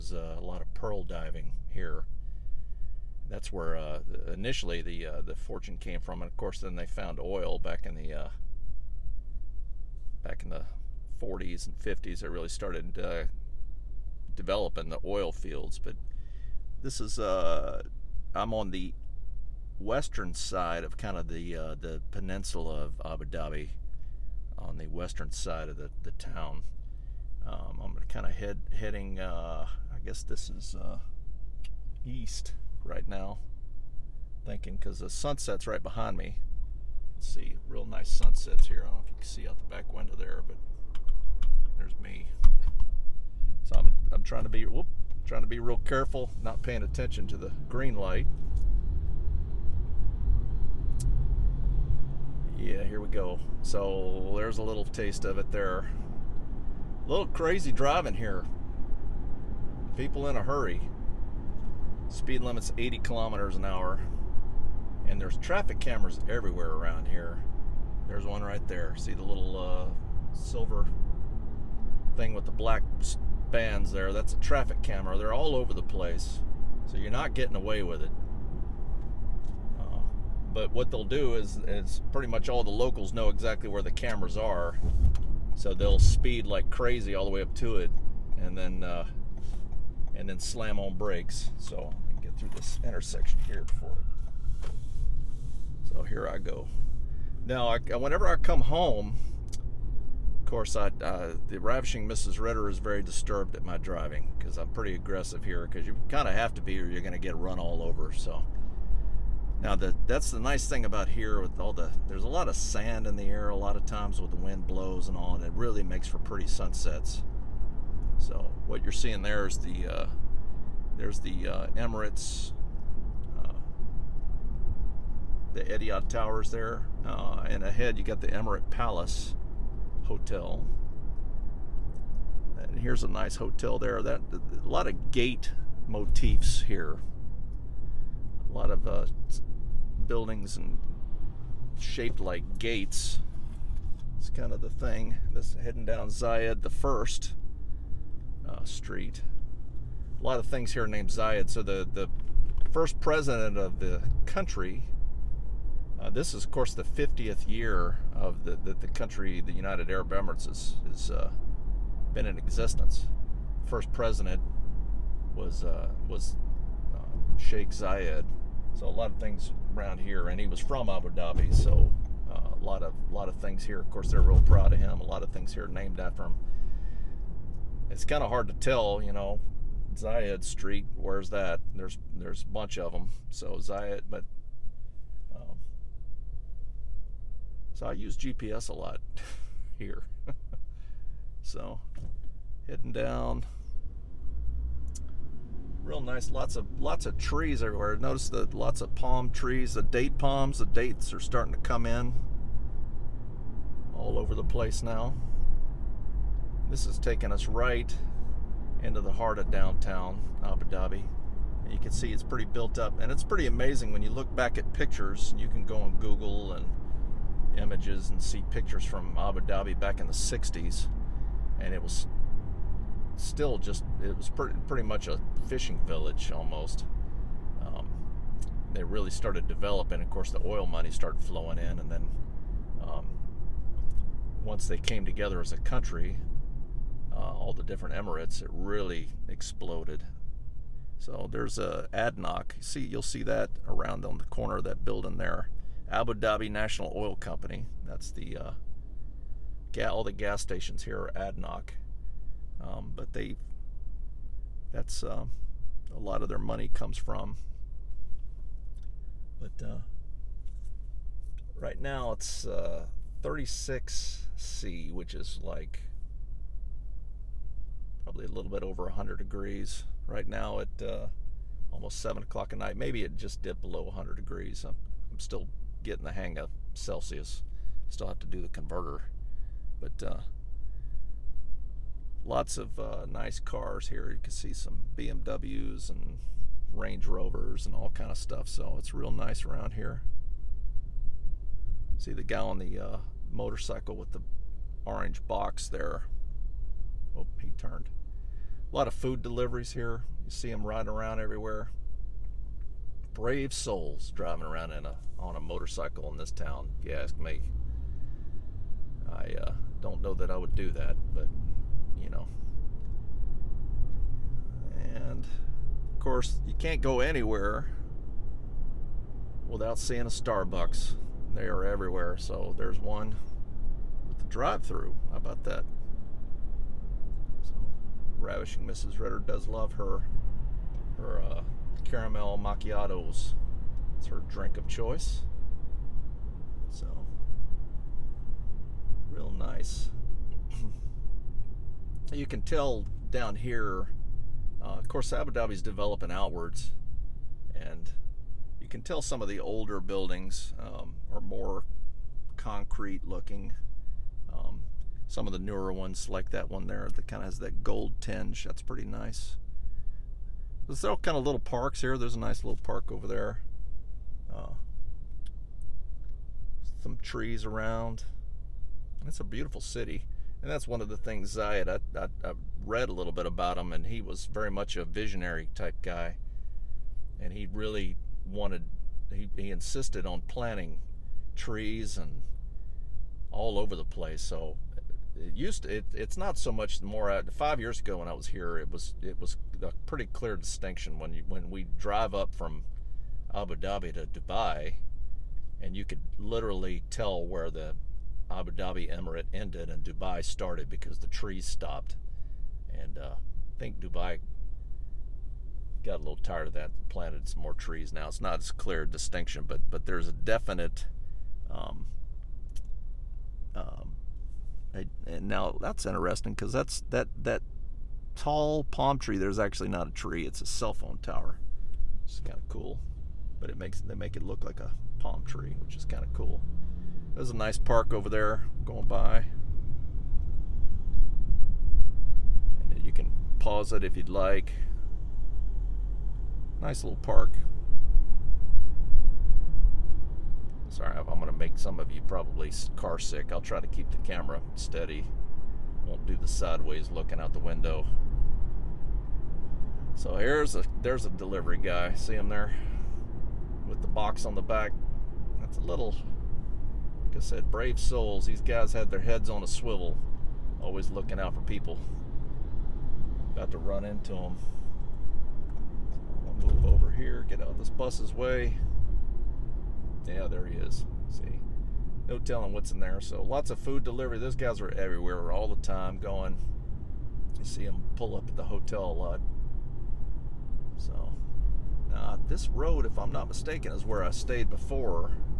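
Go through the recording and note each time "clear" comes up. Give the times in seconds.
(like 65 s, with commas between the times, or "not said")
390 s, 408 s.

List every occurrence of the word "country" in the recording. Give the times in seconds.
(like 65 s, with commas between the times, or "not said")
154 s, 158 s, 235 s.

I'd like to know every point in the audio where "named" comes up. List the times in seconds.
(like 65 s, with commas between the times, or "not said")
150 s, 175 s.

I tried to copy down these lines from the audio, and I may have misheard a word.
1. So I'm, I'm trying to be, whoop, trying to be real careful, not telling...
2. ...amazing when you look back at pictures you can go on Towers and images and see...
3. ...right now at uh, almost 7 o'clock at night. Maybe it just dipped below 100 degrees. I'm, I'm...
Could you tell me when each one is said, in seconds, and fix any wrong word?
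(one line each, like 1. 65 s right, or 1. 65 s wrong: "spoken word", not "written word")
1. 43 s wrong: "paying", not "telling"
2. 213 s wrong: "Google", not "Towers"
3. 270 s right.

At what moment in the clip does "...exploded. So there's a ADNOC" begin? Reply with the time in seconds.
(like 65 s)
239 s.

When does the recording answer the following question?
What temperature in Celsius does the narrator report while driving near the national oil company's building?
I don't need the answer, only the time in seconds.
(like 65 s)
263 s.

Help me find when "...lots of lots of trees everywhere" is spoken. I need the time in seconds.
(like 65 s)
196 s.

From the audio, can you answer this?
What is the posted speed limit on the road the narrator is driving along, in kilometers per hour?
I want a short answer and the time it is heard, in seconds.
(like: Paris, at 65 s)
80, at 62 s.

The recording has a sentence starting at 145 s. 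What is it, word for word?
This heading down Zayed the first uh, street.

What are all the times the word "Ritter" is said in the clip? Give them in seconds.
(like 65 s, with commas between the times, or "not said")
102 s, 328 s.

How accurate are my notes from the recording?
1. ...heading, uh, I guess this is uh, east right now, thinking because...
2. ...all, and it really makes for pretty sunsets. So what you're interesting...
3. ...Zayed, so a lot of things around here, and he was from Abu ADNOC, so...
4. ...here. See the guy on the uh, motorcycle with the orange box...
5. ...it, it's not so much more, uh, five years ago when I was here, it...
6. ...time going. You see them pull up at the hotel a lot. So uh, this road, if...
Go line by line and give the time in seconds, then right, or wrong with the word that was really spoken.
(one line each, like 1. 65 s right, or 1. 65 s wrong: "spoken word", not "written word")
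1. 28 s right
2. 115 s wrong: "seeing", not "interesting"
3. 167 s wrong: "Dhabi", not "ADNOC"
4. 289 s right
5. 385 s right
6. 475 s right.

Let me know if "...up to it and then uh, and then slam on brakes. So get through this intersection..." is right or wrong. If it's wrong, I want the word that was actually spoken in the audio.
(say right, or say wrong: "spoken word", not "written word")
right.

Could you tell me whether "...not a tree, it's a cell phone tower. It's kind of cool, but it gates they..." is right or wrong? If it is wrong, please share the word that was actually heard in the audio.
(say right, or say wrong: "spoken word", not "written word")
wrong: "makes", not "gates".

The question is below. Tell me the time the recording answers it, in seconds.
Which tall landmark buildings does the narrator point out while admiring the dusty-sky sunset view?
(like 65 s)
125 s.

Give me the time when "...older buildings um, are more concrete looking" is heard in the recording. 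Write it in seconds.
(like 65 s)
349 s.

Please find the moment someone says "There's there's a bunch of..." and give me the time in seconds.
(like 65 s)
181 s.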